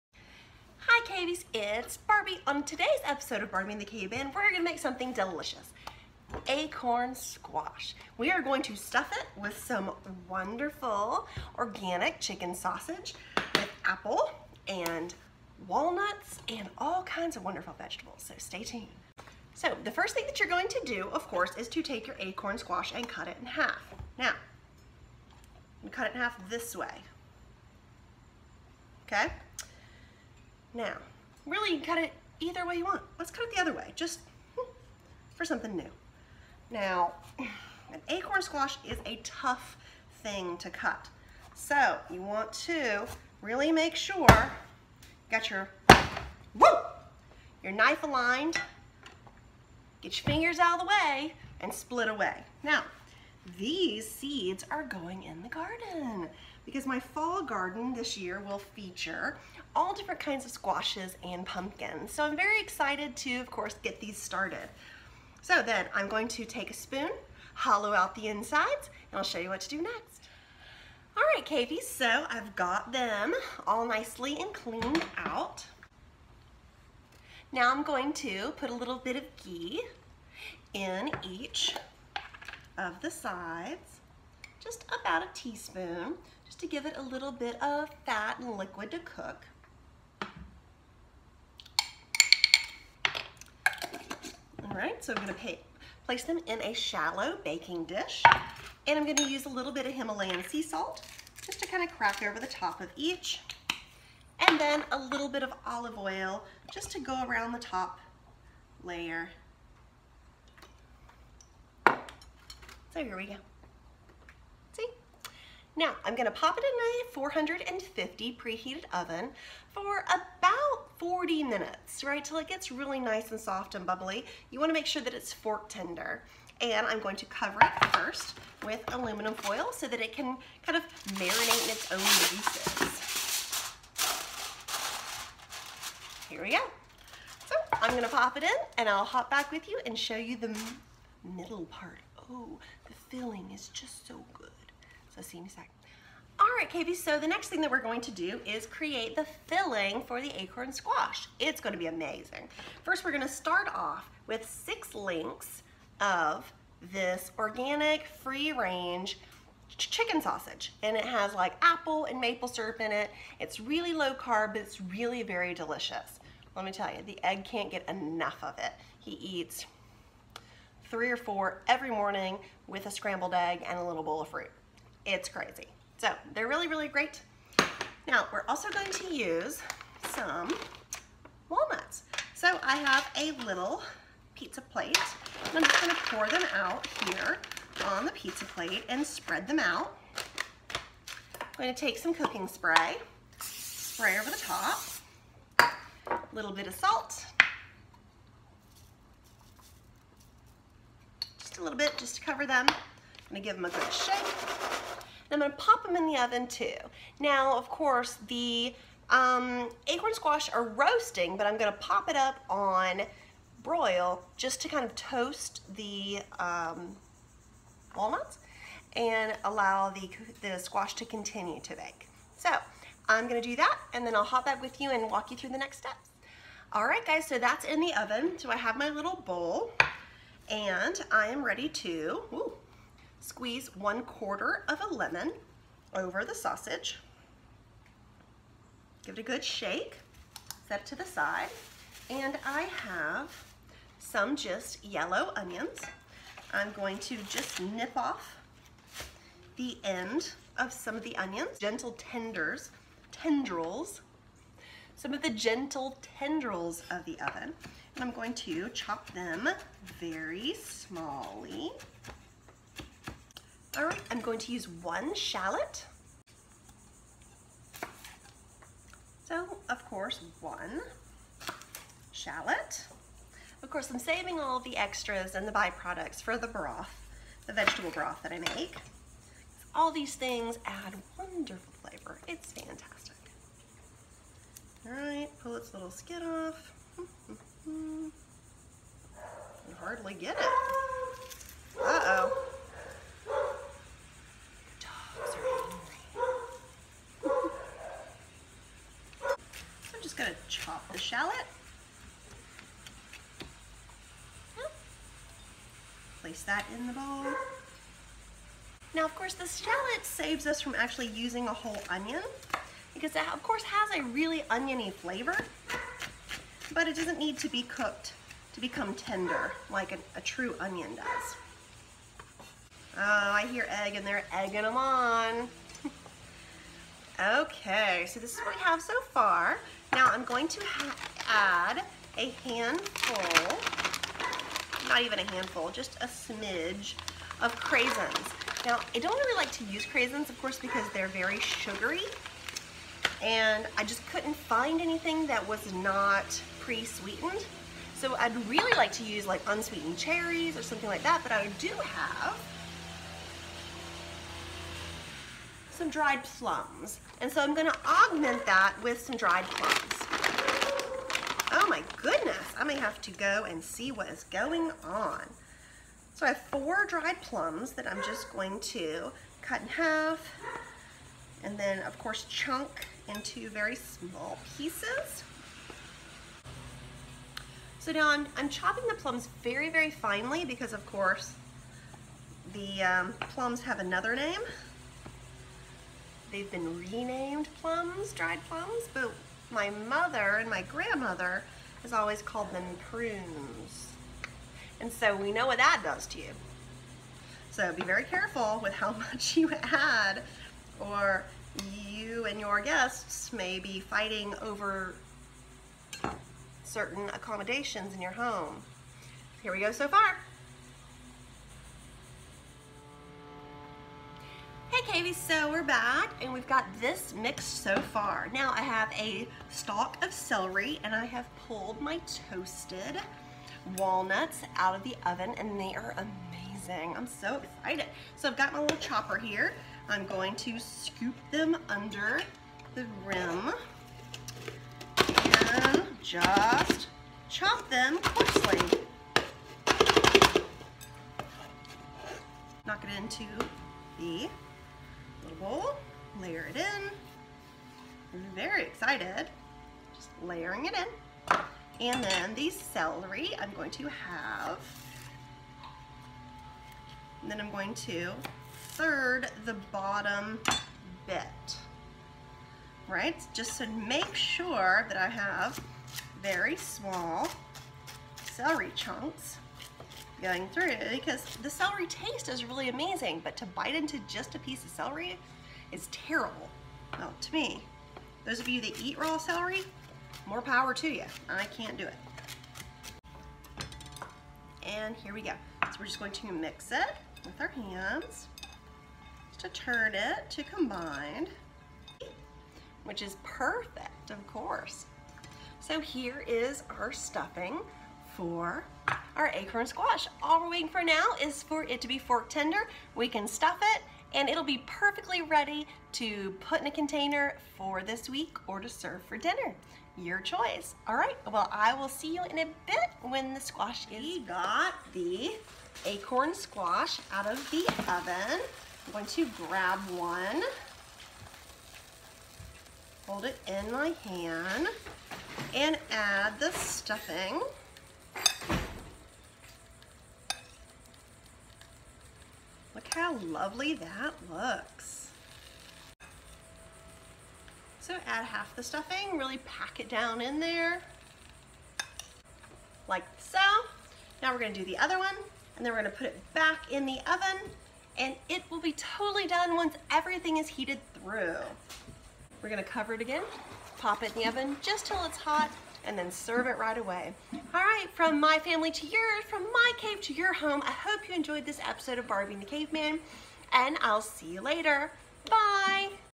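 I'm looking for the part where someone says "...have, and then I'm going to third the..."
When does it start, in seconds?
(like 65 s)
453 s.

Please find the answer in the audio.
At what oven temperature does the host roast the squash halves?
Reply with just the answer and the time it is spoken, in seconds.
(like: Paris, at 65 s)
450, at 117 s.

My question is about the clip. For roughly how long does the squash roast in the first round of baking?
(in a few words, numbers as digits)
40 minutes.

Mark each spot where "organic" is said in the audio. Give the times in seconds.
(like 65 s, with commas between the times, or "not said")
11 s, 157 s.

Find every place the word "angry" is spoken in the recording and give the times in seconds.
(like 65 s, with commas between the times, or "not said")
295 s.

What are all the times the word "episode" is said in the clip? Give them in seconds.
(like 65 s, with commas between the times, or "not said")
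3 s, 561 s.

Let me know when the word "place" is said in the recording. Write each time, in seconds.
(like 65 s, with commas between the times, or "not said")
96 s, 306 s.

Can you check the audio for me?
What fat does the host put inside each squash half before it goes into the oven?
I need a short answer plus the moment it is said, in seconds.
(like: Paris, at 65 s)
Ghee, at 79 s.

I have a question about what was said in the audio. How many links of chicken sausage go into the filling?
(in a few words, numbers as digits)
6.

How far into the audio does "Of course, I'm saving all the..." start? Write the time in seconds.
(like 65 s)
273 s.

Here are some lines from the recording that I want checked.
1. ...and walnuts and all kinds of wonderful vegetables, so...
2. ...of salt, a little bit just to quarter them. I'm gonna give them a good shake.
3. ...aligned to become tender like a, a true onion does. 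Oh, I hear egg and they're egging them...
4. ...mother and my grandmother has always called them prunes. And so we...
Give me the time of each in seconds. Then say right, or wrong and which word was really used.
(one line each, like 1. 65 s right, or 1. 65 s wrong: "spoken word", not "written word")
1. 14 s right
2. 196 s wrong: "cover", not "quarter"
3. 317 s wrong: "cooked", not "aligned"
4. 389 s right.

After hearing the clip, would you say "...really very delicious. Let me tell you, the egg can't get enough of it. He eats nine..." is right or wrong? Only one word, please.
wrong.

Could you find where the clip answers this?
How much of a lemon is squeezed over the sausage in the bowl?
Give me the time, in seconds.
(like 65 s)
233 s.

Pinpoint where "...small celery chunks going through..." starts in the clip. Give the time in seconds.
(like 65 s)
466 s.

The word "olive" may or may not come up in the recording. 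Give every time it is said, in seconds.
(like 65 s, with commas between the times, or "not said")
105 s.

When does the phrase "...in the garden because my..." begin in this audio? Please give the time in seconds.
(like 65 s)
55 s.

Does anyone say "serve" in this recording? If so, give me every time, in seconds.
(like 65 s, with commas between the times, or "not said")
508 s, 556 s.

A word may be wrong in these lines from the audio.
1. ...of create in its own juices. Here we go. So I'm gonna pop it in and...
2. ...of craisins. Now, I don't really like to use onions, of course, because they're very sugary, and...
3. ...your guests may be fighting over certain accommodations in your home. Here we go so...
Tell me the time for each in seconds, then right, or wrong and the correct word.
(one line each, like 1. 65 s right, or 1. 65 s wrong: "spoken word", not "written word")
1. 130 s wrong: "marinate", not "create"
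2. 337 s wrong: "craisins", not "onions"
3. 402 s right.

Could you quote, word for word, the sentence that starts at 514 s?
We got the acorn squash out of the oven going to grab one, hold it in my hand, and add the stuffing.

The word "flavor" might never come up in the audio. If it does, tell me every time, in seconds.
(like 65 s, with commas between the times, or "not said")
281 s, 314 s.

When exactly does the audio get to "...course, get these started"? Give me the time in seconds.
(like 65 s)
63 s.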